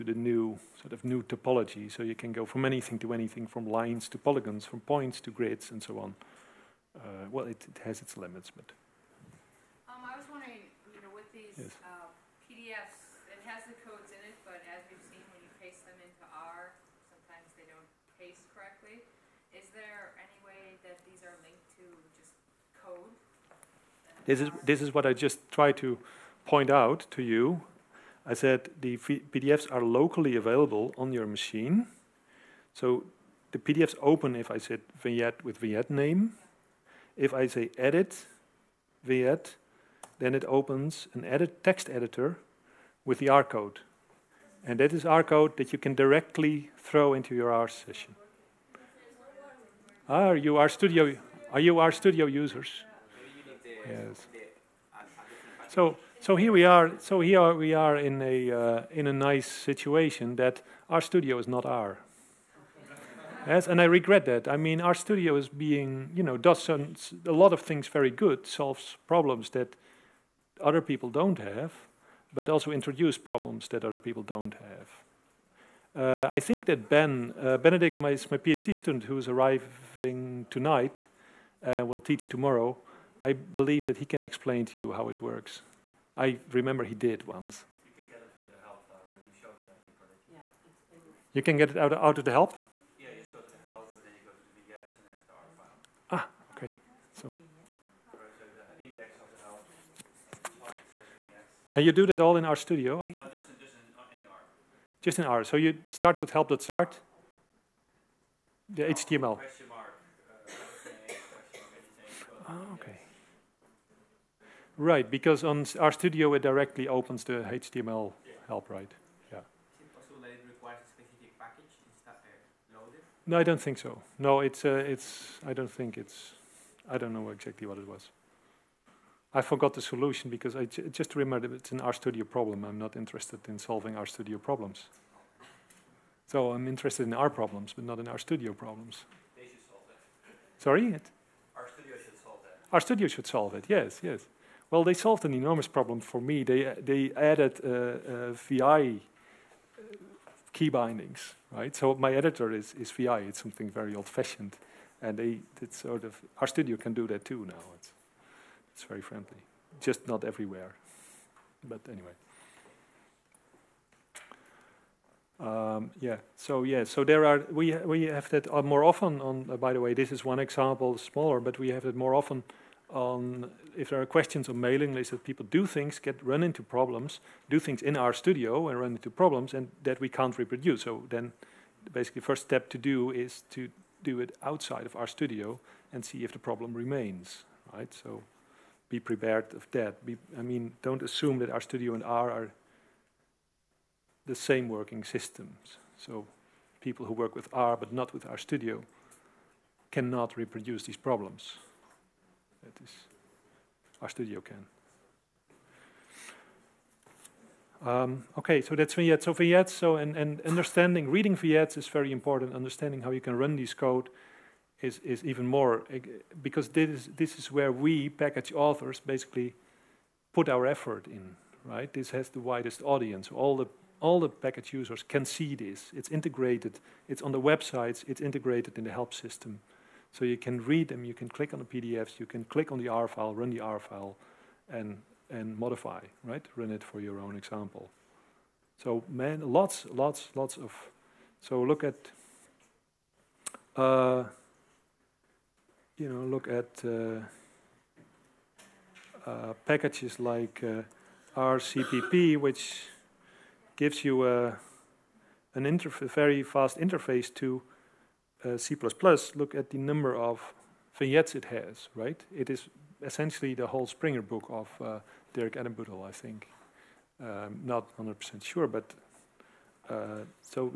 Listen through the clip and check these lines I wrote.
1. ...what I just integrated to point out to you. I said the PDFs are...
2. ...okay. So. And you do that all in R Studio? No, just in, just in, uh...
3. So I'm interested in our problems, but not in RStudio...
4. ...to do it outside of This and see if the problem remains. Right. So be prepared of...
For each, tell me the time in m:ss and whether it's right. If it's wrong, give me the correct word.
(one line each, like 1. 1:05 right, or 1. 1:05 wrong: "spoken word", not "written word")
1. 0:24 wrong: "tried", not "integrated"
2. 1:36 right
3. 2:16 right
4. 3:03 wrong: "RStudio", not "This".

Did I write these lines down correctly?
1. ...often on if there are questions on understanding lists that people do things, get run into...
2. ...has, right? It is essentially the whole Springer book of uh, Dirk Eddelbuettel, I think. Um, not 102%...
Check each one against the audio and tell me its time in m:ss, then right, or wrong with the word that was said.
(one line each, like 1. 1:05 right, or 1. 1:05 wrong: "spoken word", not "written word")
1. 2:52 wrong: "mailing", not "understanding"
2. 4:21 wrong: "100", not "102".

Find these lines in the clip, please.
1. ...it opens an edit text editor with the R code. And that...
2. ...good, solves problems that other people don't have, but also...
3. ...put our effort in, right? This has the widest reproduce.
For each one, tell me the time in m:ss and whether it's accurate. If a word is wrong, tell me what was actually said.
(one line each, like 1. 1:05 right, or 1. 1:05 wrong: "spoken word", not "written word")
1. 0:40 right
2. 1:08 right
3. 3:40 wrong: "audience", not "reproduce".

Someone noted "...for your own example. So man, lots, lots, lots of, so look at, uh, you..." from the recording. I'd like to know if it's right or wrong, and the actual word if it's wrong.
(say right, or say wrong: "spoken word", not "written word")
right.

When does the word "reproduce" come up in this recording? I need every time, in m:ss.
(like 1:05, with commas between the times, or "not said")
3:00, 3:20.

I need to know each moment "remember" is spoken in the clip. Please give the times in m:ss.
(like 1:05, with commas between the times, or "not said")
1:26, 2:11.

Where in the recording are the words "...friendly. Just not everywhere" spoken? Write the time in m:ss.
2:39.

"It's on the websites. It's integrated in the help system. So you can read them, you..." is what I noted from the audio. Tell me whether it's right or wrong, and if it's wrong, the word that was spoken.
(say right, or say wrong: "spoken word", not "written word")
right.